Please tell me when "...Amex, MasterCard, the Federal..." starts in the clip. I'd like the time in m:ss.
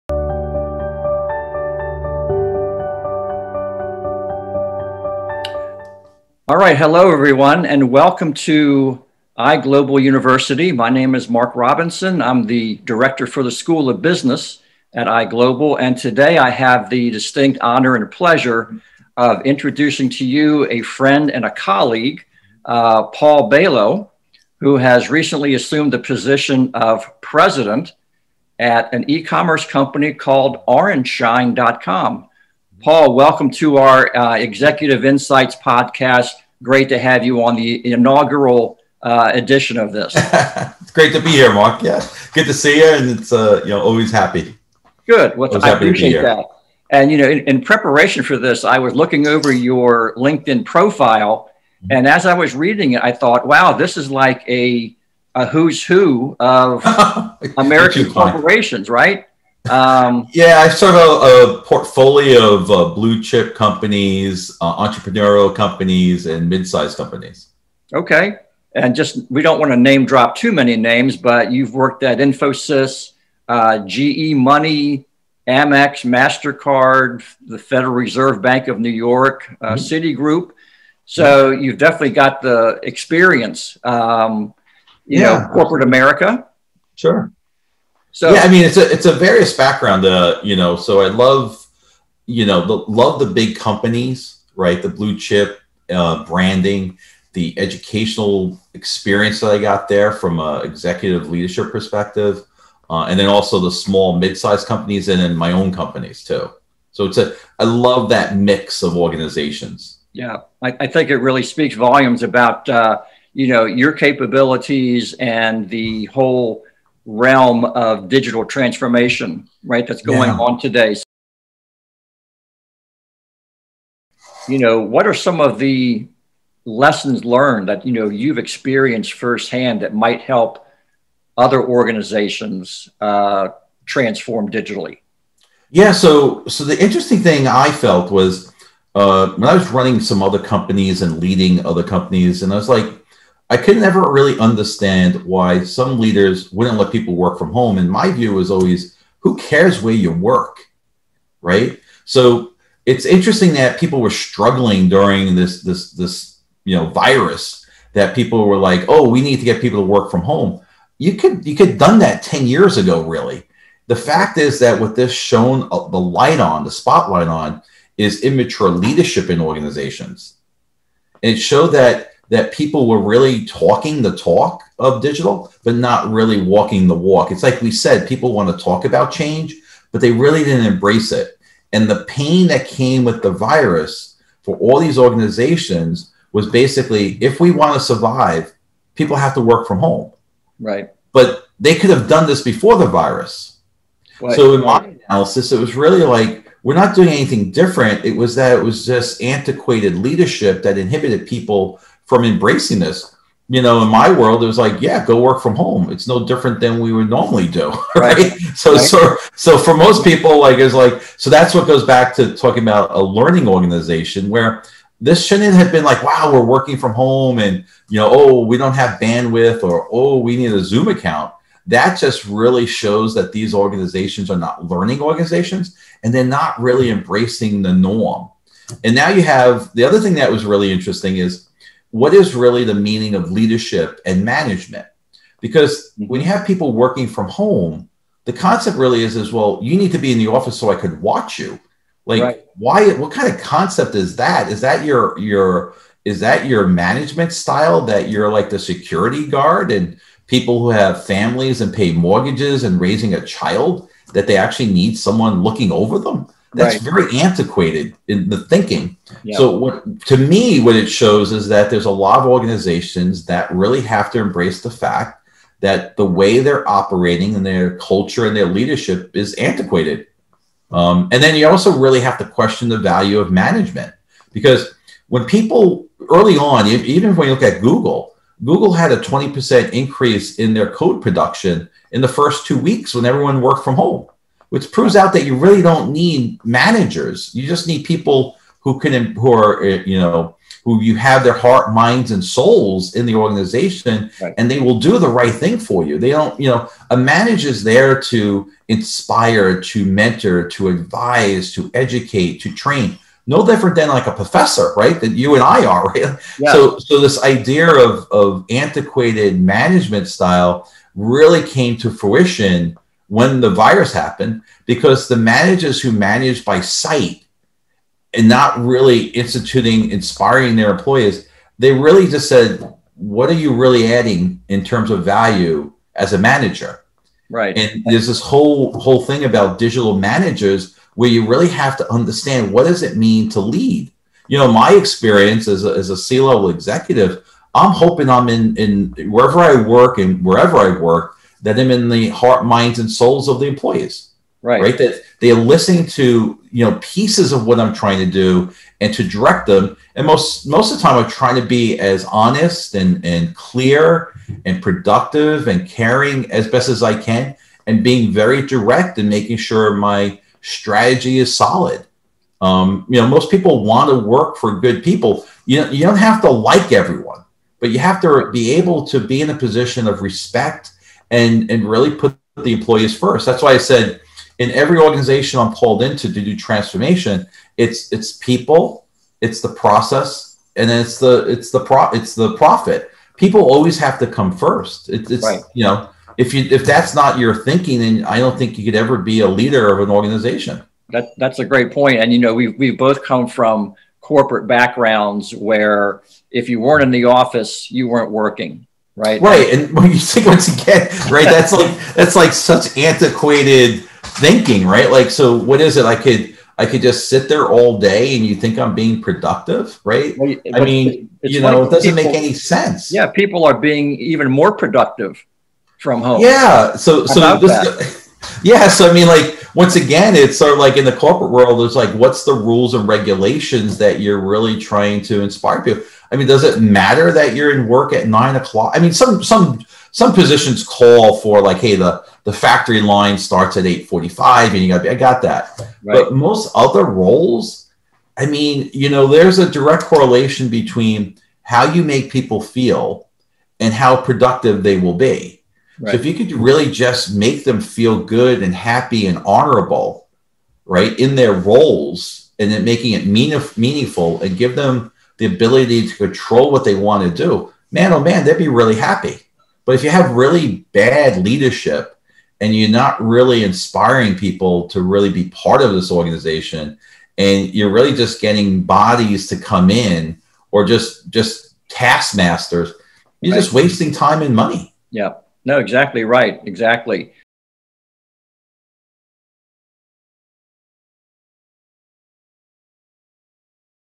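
1:15.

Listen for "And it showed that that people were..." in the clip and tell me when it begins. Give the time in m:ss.
2:51.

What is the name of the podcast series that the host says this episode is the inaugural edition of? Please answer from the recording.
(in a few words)
Executive Insights.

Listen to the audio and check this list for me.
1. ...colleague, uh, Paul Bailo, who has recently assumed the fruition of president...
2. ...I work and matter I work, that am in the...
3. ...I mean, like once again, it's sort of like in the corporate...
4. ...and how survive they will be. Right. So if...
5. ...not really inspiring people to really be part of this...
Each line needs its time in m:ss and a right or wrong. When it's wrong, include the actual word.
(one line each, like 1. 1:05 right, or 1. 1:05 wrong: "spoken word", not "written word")
1. 0:21 wrong: "position", not "fruition"
2. 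5:39 wrong: "wherever", not "matter"
3. 6:58 right
4. 7:23 wrong: "productive", not "survive"
5. 7:42 right.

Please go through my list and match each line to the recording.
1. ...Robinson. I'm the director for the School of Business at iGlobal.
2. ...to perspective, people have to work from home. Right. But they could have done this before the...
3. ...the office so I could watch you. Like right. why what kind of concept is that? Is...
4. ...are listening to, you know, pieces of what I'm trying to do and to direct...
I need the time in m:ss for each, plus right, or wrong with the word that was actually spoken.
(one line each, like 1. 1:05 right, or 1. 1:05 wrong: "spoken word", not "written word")
1. 0:11 right
2. 3:07 wrong: "survive", not "perspective"
3. 4:00 right
4. 5:45 right.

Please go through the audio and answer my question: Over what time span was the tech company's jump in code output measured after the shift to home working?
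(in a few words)
first 2 weeks.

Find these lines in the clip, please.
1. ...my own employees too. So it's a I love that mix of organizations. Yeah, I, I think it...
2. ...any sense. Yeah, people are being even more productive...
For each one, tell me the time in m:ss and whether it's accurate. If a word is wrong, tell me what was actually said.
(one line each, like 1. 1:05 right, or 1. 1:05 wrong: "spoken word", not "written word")
1. 1:45 wrong: "companies", not "employees"
2. 6:52 right.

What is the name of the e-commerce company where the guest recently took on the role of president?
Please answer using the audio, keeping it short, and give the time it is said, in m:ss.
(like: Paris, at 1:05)
orangeshine.com, at 0:30.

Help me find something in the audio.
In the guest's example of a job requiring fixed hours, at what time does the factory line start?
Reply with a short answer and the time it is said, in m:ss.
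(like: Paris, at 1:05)
8:45, at 7:13.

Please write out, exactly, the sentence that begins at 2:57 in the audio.
It's like we said, people want to talk about change, but they really didn't embrace it.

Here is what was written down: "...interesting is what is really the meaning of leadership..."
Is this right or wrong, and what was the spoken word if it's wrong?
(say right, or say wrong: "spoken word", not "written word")
right.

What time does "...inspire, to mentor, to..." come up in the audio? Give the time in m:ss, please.
4:58.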